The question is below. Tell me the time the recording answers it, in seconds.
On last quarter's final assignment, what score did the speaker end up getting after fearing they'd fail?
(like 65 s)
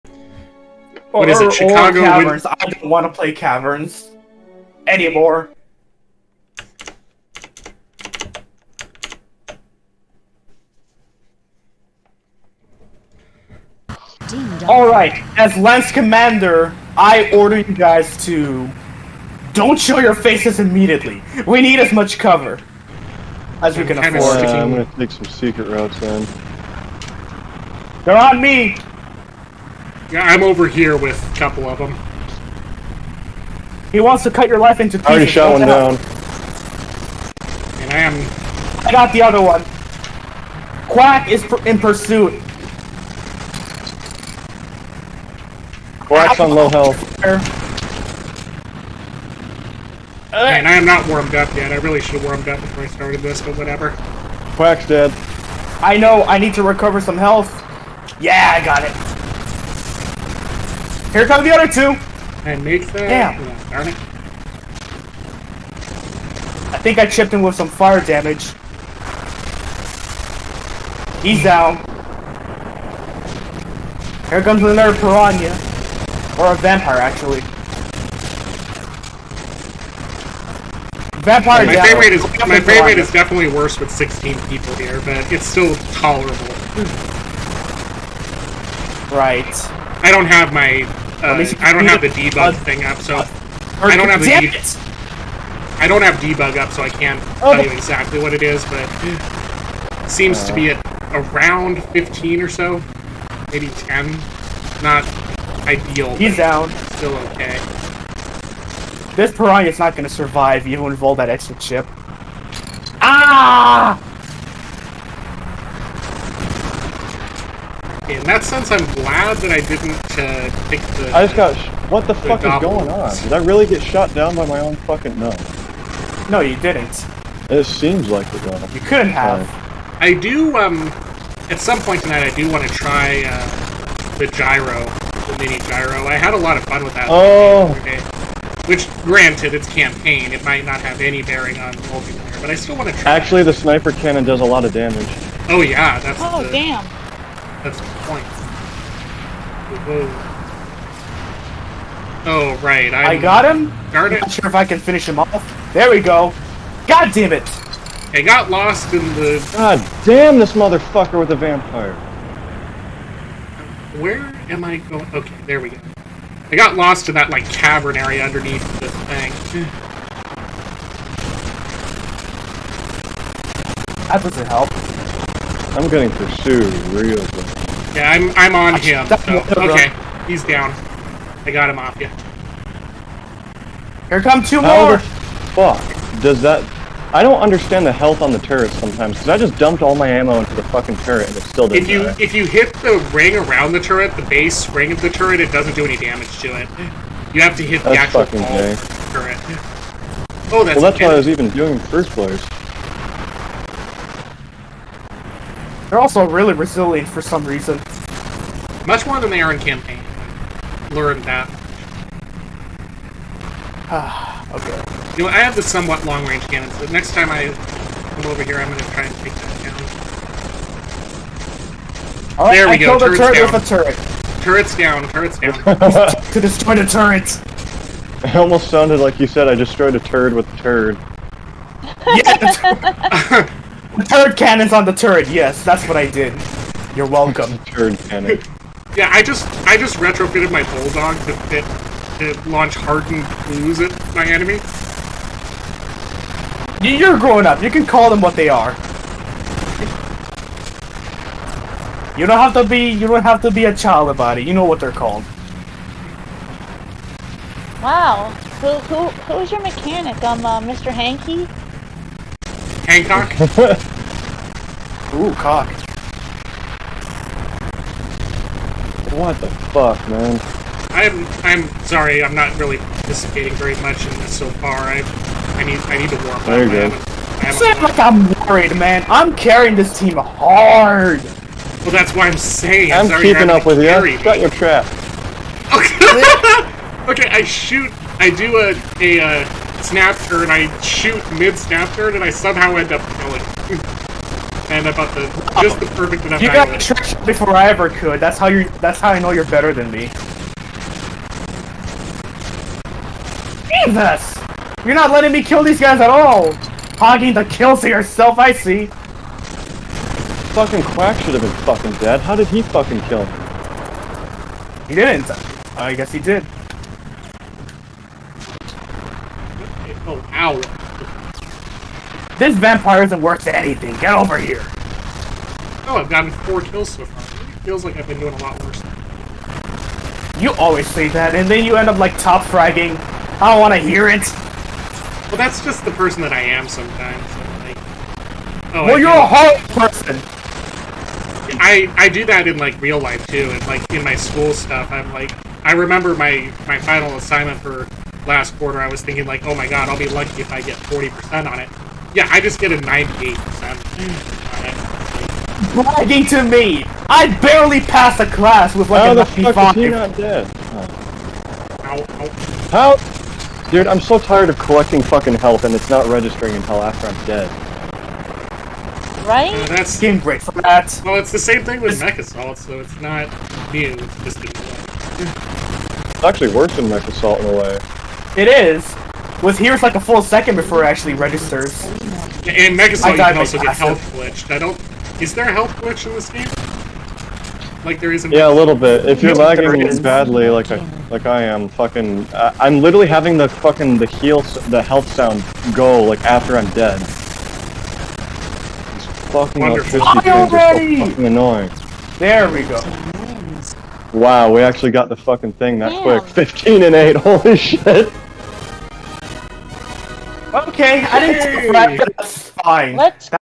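352 s.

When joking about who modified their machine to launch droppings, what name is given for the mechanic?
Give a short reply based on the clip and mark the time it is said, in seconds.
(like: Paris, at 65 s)
Mr. Hankey, at 260 s.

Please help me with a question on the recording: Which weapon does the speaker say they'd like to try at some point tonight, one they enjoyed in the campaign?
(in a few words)
mini gyro.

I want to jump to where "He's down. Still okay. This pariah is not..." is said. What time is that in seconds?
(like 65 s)
106 s.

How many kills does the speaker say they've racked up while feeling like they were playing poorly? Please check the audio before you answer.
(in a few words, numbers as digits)
4.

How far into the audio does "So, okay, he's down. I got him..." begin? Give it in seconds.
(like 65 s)
179 s.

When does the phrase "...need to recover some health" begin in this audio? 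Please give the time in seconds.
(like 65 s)
56 s.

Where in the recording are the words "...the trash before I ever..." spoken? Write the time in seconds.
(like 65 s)
296 s.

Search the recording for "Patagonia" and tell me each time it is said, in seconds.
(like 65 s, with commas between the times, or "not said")
not said.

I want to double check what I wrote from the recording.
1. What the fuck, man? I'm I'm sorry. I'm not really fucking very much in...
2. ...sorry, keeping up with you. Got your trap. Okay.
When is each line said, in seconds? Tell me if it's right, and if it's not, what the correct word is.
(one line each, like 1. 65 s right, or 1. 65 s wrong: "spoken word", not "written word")
1. 269 s wrong: "participating", not "fucking"
2. 283 s right.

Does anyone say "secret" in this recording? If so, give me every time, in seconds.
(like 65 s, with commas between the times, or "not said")
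25 s.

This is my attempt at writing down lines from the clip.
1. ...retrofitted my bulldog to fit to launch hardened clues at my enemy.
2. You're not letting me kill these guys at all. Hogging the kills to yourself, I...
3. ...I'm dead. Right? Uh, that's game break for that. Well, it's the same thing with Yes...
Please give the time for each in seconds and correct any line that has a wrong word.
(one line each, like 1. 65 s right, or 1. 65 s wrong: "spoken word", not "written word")
1. 239 s right
2. 304 s right
3. 367 s wrong: "Mech", not "Yes".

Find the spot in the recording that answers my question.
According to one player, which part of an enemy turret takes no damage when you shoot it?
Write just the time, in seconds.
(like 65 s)
194 s.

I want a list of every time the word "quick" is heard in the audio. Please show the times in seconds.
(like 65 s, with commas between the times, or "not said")
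406 s.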